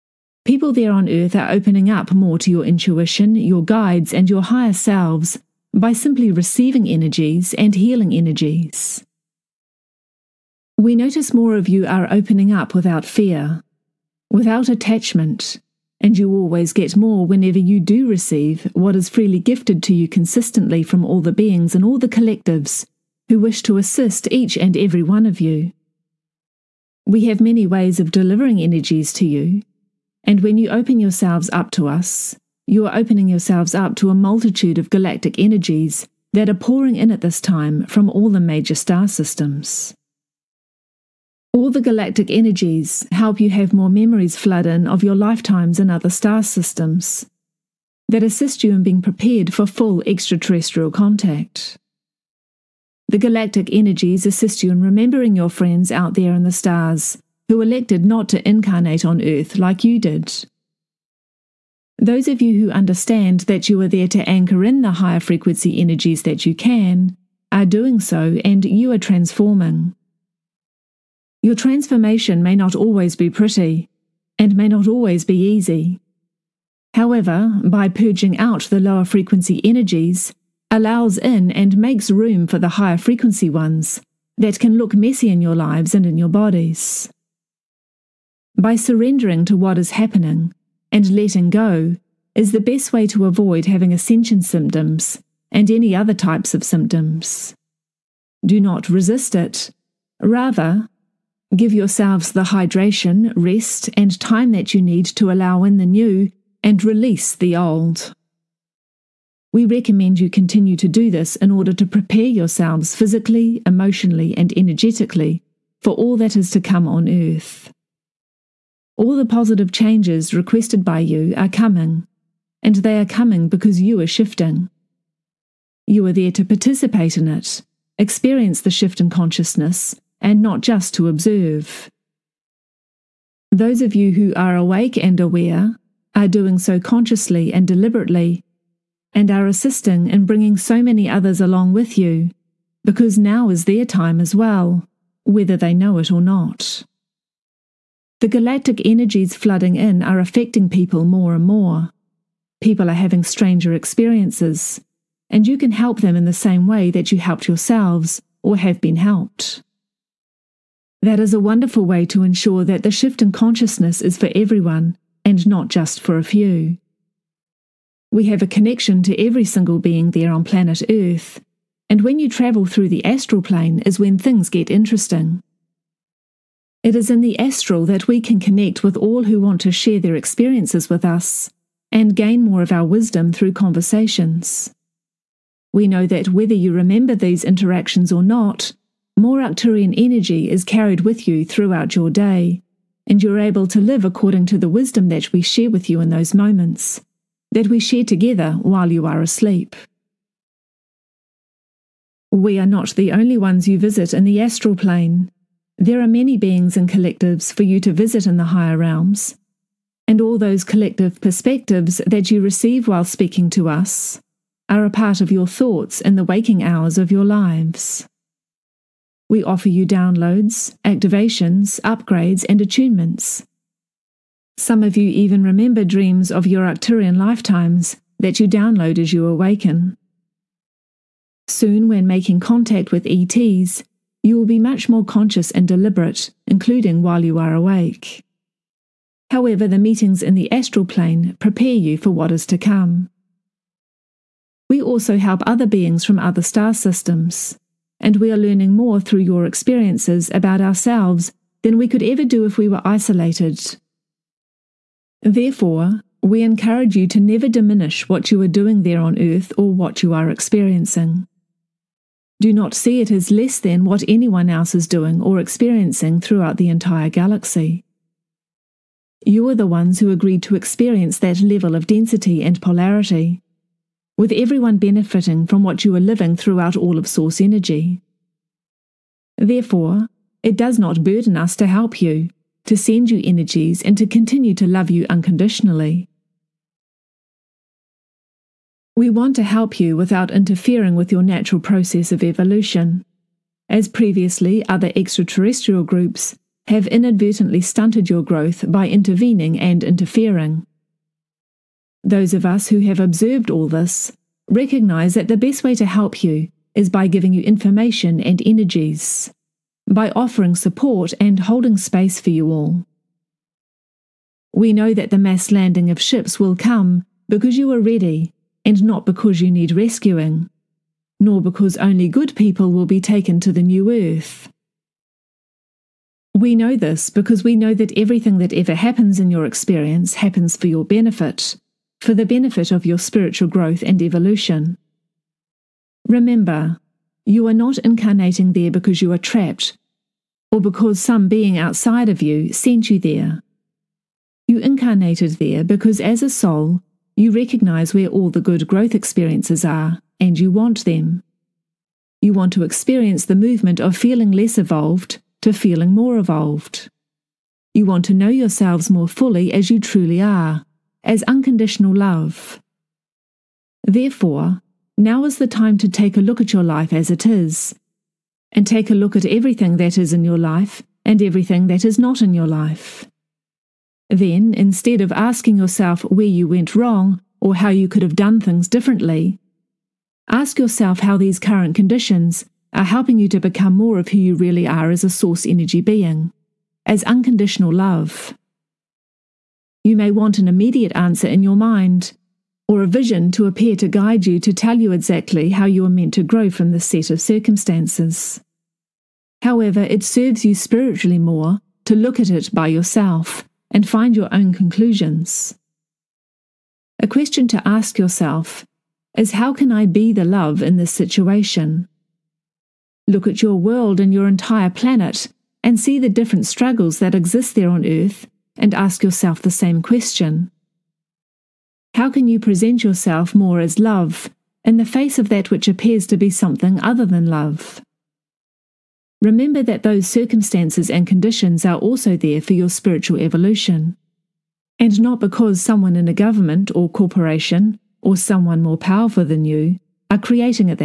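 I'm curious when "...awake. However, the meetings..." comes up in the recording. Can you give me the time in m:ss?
3:57.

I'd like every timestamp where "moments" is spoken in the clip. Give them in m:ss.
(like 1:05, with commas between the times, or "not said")
3:16.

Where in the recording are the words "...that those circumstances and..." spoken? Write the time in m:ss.
7:09.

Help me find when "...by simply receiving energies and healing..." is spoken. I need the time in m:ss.
0:05.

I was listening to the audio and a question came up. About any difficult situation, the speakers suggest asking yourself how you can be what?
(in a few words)
The love.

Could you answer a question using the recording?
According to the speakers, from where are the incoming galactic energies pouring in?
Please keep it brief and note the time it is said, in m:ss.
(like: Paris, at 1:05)
All the major star systems, at 0:38.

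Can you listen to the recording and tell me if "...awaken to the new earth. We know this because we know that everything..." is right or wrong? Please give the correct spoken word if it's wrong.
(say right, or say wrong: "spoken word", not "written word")
wrong: "taken", not "awaken".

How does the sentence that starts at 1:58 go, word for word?
All the positive changes requested by you are coming, and they are coming because you are shifting.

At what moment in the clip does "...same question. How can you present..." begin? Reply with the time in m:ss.
6:59.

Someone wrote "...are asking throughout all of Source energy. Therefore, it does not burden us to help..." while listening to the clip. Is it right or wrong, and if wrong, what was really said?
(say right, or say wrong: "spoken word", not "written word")
wrong: "living", not "asking".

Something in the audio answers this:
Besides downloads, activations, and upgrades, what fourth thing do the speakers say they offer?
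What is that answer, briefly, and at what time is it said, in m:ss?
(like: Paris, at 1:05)
Attunements, at 3:42.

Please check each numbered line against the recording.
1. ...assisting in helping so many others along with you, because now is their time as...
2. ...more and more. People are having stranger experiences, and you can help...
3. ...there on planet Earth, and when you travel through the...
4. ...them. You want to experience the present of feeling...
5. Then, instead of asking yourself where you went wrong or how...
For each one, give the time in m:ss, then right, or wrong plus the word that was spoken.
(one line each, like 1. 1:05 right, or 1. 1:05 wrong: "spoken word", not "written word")
1. 2:19 wrong: "bringing", not "helping"
2. 2:31 right
3. 2:50 right
4. 5:50 wrong: "movement", not "present"
5. 6:14 right.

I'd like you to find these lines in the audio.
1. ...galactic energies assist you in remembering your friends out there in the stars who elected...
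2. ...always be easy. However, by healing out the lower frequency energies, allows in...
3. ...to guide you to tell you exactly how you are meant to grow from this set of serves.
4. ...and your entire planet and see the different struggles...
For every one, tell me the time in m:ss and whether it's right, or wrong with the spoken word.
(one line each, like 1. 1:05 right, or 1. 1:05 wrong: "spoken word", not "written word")
1. 0:53 right
2. 1:14 wrong: "purging", not "healing"
3. 6:33 wrong: "circumstances", not "serves"
4. 6:53 right.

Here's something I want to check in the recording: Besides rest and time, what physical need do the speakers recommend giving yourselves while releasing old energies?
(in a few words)
Hydration.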